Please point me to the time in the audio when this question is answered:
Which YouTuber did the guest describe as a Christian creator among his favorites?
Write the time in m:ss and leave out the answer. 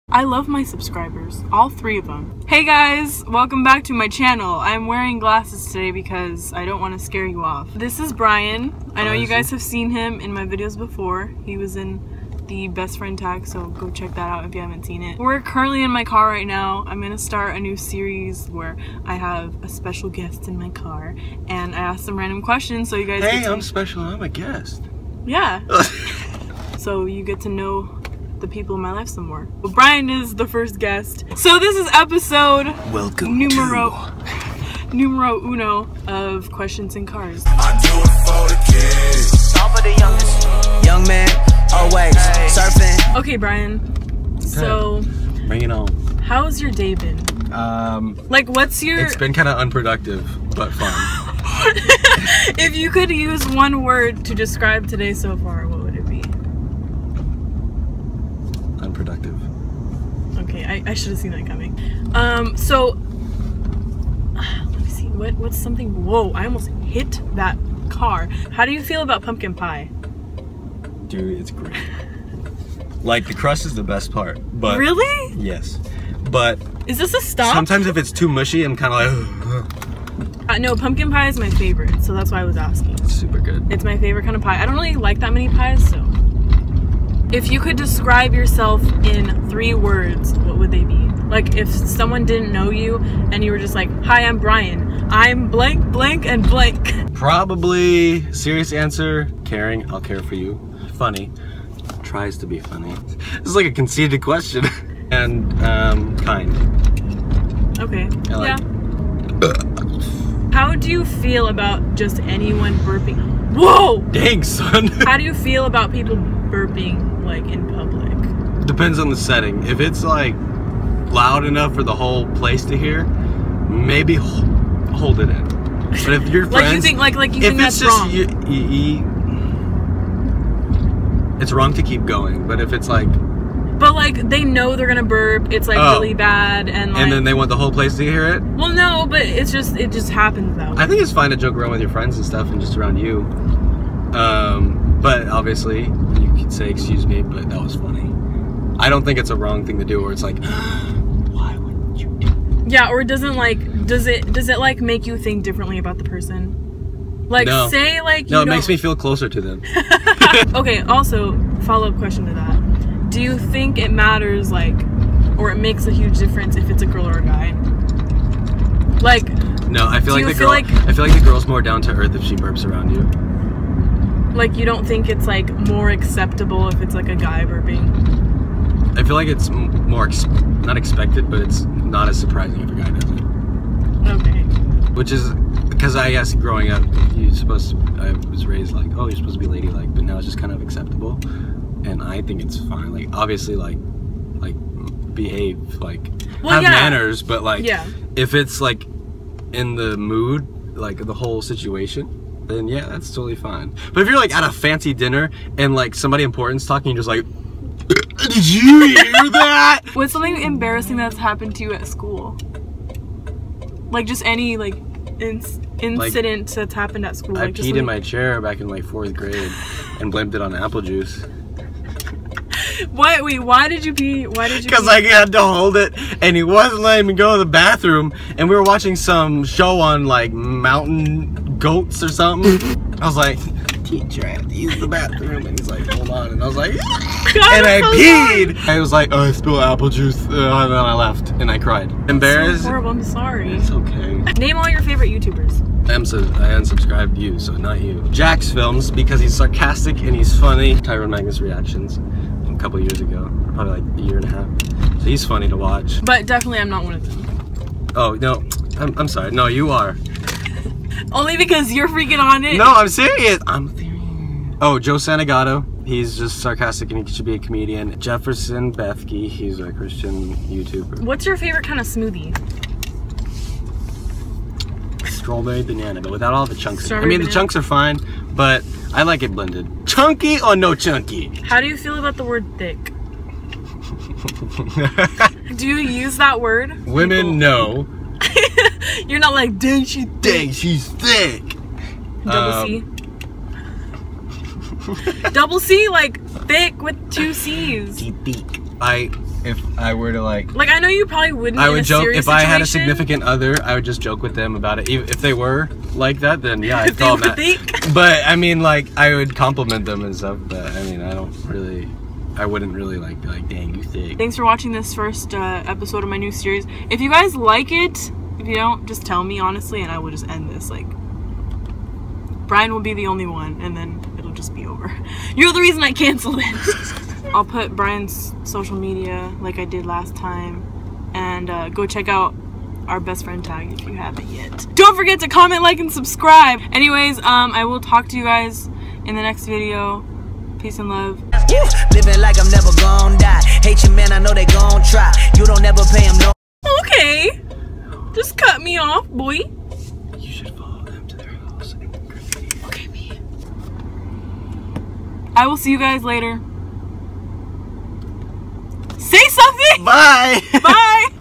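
4:27.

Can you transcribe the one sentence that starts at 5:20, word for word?
Like, Brian will be the only one, and then it'll just be over.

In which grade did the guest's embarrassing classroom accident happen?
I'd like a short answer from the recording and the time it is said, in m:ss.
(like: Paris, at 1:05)
Fourth grade, at 3:38.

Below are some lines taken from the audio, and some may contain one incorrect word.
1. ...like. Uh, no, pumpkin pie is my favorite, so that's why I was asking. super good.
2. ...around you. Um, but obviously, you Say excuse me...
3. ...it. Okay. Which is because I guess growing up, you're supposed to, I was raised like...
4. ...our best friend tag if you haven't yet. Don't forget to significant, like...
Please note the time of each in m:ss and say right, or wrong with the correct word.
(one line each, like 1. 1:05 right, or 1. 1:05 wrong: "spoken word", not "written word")
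1. 1:19 right
2. 2:22 right
3. 3:03 right
4. 5:32 wrong: "comment", not "significant".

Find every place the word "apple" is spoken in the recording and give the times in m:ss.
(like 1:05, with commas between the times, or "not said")
3:40, 3:59.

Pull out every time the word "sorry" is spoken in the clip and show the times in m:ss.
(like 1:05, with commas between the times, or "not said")
4:03, 4:19.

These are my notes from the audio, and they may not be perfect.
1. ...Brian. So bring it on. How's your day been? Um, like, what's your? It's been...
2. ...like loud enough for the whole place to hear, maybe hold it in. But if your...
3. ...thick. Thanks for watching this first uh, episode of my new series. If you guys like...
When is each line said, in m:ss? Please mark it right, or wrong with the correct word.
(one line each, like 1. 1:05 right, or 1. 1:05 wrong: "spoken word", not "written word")
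1. 0:43 right
2. 2:00 right
3. 5:13 right.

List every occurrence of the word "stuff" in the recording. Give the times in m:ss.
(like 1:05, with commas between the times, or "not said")
2:22, 5:10.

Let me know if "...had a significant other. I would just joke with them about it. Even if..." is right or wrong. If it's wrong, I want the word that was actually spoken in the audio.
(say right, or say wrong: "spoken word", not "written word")
right.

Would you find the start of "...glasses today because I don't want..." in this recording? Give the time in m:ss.
0:05.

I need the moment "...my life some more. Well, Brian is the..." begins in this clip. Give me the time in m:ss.
0:28.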